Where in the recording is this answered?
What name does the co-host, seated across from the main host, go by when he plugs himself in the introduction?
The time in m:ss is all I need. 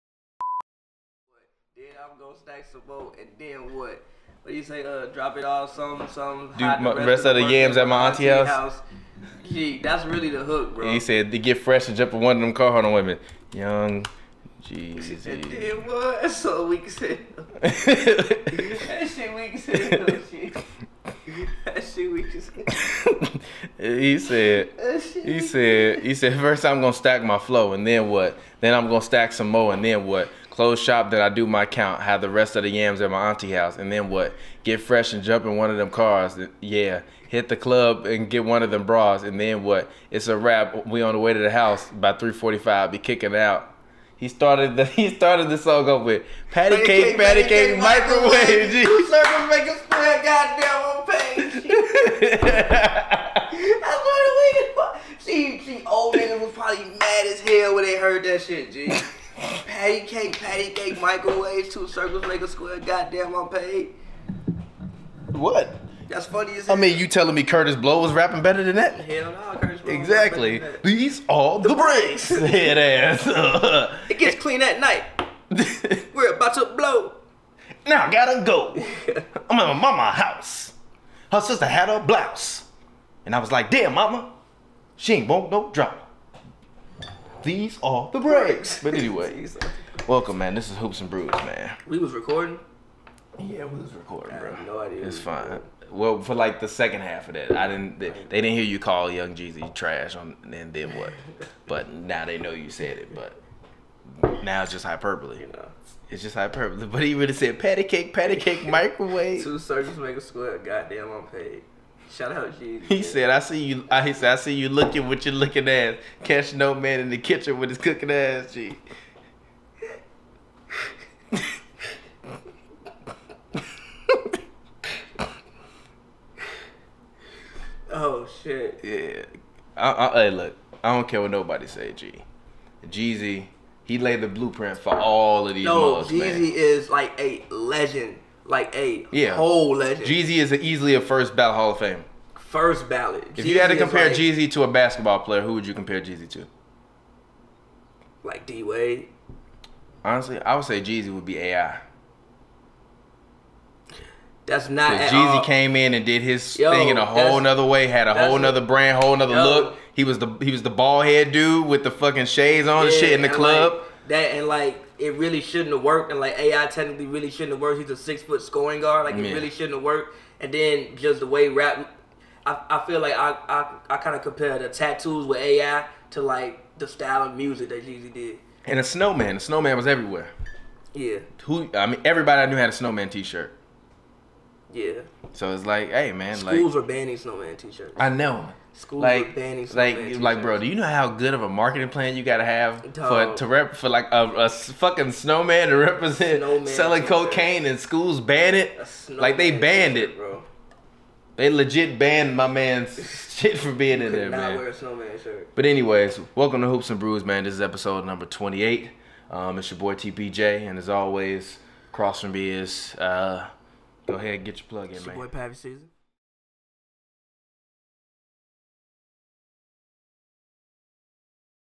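3:35.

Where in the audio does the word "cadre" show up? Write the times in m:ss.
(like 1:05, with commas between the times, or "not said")
not said.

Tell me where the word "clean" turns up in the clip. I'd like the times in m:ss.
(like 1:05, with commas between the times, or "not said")
1:14.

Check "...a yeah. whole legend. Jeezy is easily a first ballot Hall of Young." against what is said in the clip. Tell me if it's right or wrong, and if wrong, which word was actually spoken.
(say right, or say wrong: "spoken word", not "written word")
wrong: "Fame", not "Young".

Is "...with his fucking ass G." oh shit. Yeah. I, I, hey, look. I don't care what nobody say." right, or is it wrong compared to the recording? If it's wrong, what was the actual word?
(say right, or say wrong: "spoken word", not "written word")
wrong: "cooking", not "fucking".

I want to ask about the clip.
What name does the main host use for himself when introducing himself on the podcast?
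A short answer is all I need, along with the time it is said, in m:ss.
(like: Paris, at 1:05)
TPJ, at 3:29.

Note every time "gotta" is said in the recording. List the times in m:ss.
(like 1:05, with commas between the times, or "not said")
1:18, 3:12.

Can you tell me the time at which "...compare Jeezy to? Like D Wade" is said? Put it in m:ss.
2:25.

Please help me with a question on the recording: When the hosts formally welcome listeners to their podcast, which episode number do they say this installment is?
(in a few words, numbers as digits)
28.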